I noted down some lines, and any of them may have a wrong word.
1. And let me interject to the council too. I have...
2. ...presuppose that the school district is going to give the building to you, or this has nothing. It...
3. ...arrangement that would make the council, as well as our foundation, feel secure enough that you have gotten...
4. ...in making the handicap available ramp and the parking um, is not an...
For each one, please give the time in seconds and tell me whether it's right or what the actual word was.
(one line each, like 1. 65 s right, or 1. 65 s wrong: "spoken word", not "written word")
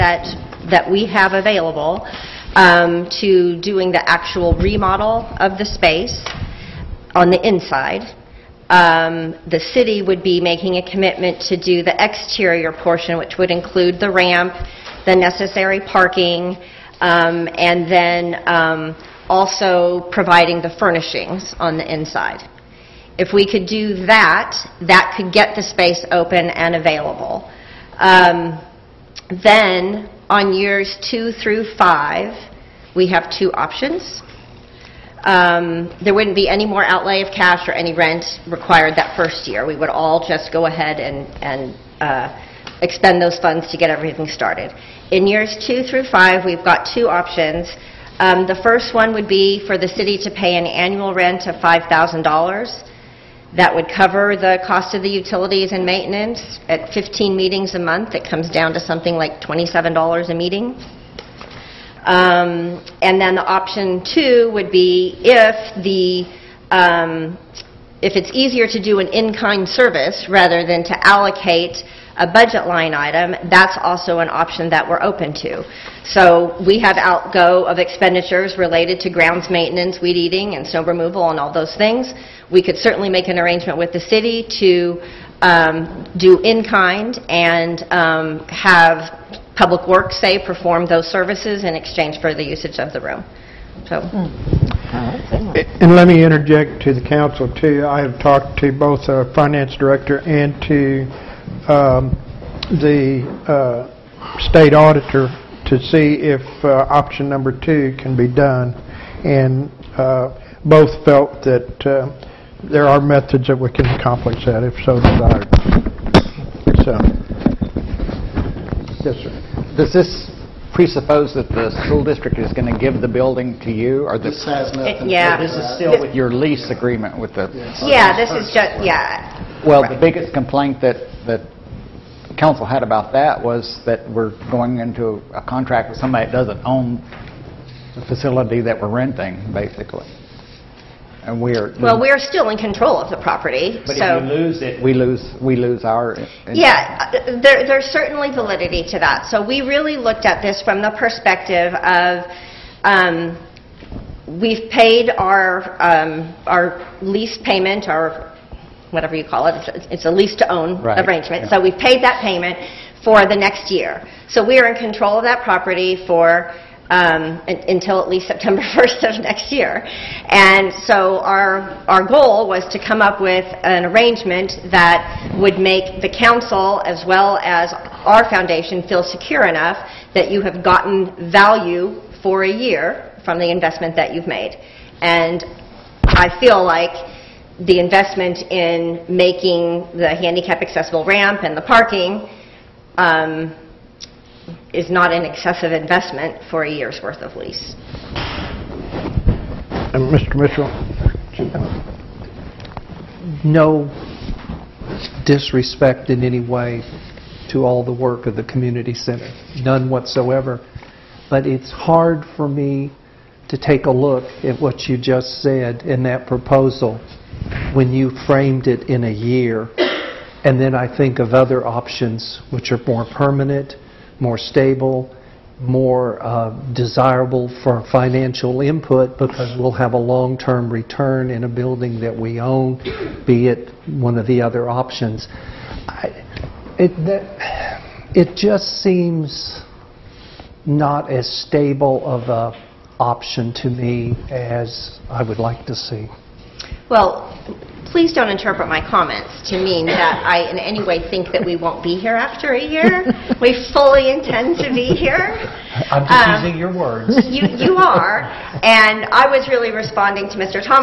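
1. 95 s right
2. 120 s right
3. 173 s right
4. 188 s wrong: "accessible", not "available".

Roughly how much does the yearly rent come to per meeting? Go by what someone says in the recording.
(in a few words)
$27.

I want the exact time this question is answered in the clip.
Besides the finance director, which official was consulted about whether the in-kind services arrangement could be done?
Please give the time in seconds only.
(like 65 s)
104 s.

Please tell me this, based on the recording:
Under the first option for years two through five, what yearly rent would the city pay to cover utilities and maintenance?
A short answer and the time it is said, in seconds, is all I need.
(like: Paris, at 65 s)
$5,000, at 51 s.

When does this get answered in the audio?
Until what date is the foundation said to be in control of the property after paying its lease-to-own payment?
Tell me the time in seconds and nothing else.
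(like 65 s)
168 s.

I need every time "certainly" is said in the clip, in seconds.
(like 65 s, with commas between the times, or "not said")
82 s, 147 s.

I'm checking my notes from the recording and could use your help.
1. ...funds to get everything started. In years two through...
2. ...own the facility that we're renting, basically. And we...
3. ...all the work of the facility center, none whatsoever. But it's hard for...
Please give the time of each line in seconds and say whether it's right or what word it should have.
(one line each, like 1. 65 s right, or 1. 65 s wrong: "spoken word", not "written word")
1. 43 s right
2. 136 s right
3. 207 s wrong: "community", not "facility".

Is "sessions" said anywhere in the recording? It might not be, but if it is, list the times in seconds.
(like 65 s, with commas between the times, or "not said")
not said.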